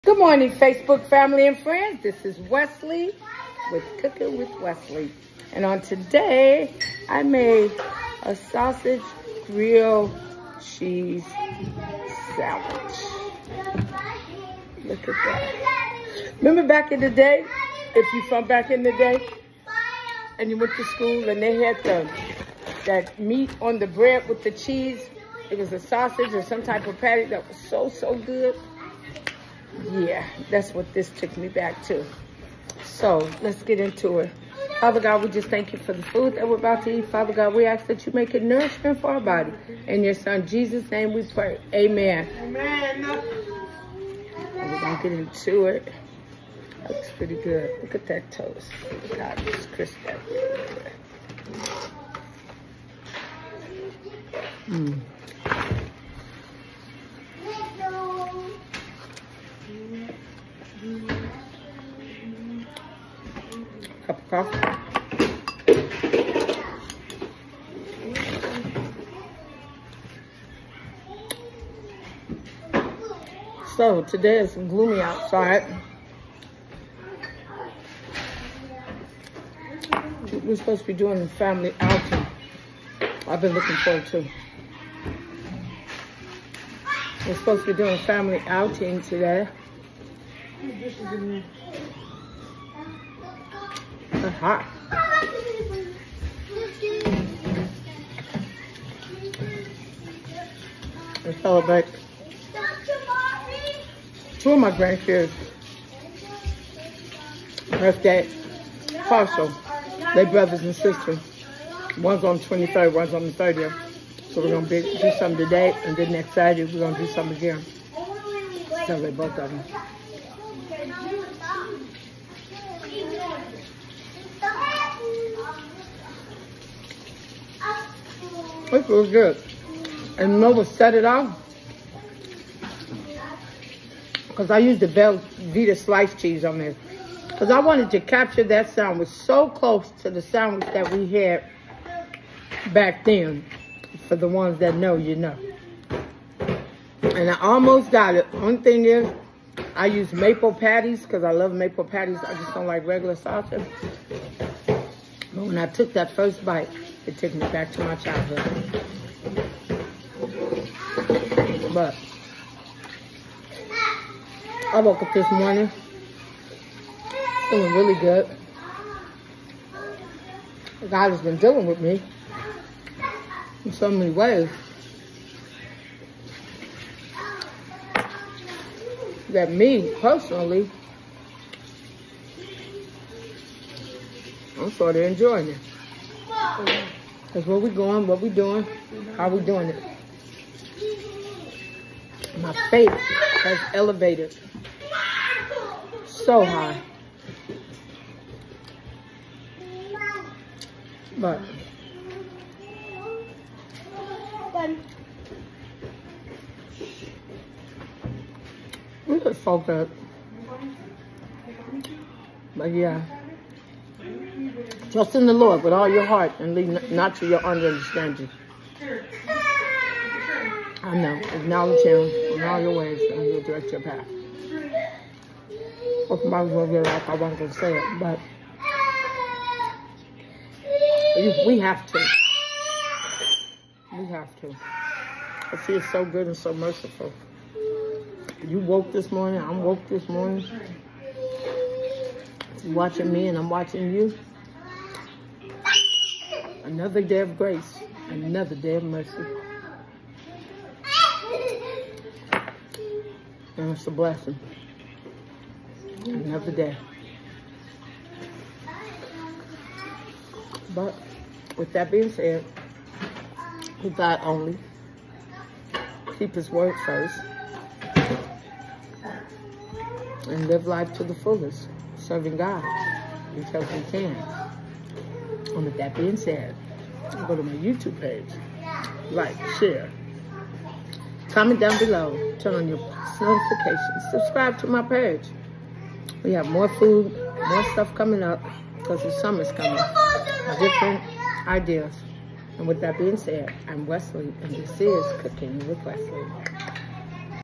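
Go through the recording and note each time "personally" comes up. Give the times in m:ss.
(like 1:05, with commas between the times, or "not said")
3:00.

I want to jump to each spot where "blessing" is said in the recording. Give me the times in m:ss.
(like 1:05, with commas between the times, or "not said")
4:13.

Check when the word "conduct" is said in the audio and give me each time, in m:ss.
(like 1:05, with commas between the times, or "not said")
not said.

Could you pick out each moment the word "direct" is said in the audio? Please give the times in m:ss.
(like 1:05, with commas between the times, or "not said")
3:43.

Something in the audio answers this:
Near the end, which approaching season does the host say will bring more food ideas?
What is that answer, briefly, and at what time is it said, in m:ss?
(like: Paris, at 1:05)
summer, at 4:49.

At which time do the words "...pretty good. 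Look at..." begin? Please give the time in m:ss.
0:47.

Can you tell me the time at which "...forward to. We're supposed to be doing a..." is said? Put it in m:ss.
1:23.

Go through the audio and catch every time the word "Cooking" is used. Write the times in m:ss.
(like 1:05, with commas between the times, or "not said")
0:03, 4:55.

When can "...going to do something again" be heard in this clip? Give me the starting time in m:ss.
1:56.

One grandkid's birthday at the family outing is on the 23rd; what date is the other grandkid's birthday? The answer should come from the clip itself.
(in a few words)
30th.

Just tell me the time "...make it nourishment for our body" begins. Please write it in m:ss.
0:38.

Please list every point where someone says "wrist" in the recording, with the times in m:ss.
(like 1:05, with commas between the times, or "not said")
not said.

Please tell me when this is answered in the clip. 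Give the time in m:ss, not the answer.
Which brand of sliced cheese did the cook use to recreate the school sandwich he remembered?
2:14.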